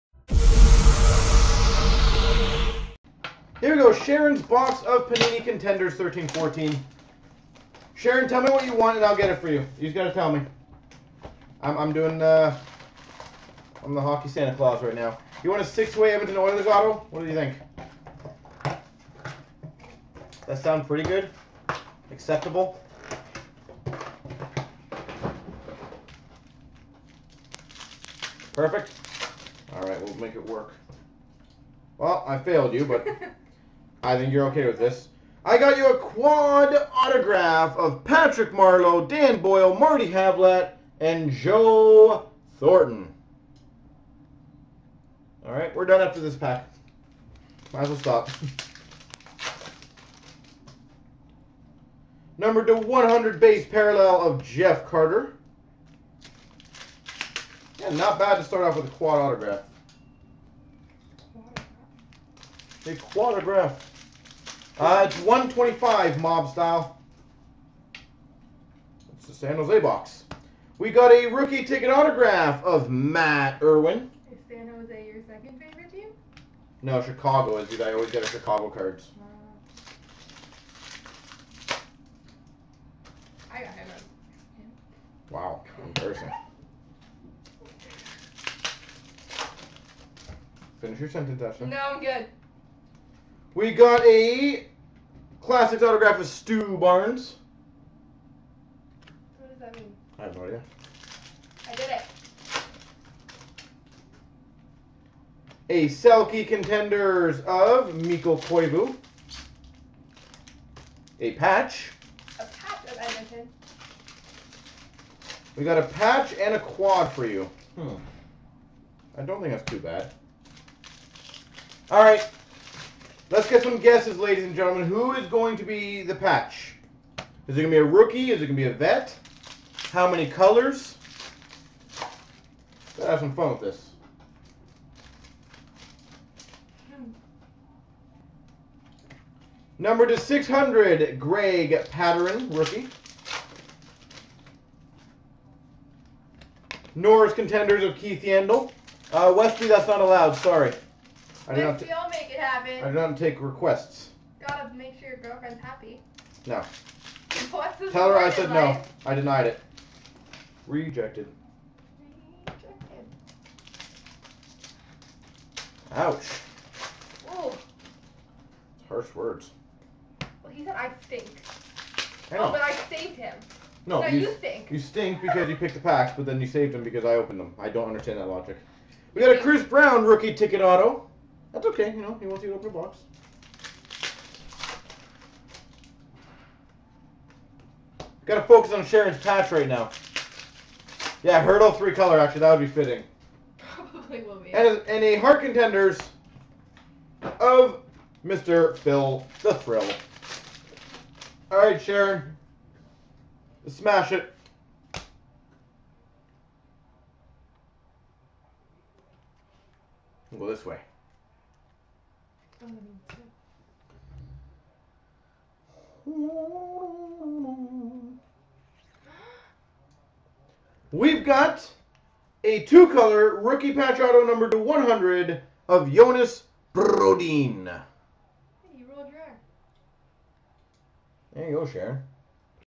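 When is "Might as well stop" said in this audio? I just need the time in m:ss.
0:47.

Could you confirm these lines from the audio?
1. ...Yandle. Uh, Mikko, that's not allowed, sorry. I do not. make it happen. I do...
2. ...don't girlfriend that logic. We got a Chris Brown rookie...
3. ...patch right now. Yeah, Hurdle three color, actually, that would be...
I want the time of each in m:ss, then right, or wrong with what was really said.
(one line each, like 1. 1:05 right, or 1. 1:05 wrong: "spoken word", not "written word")
1. 2:28 wrong: "Wesley", not "Mikko"
2. 2:57 wrong: "understand", not "girlfriend"
3. 3:09 right.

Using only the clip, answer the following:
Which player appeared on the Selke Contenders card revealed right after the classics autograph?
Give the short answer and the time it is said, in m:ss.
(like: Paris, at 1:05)
Mikko Koivu, at 1:48.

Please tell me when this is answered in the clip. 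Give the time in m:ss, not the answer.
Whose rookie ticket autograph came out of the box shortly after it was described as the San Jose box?
1:12.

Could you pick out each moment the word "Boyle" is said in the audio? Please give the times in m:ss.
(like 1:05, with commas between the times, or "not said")
0:39.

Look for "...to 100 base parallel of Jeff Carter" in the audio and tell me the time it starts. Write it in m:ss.
0:52.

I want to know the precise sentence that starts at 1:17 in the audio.
I always get a Chicago cards.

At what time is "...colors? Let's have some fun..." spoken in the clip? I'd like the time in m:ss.
2:10.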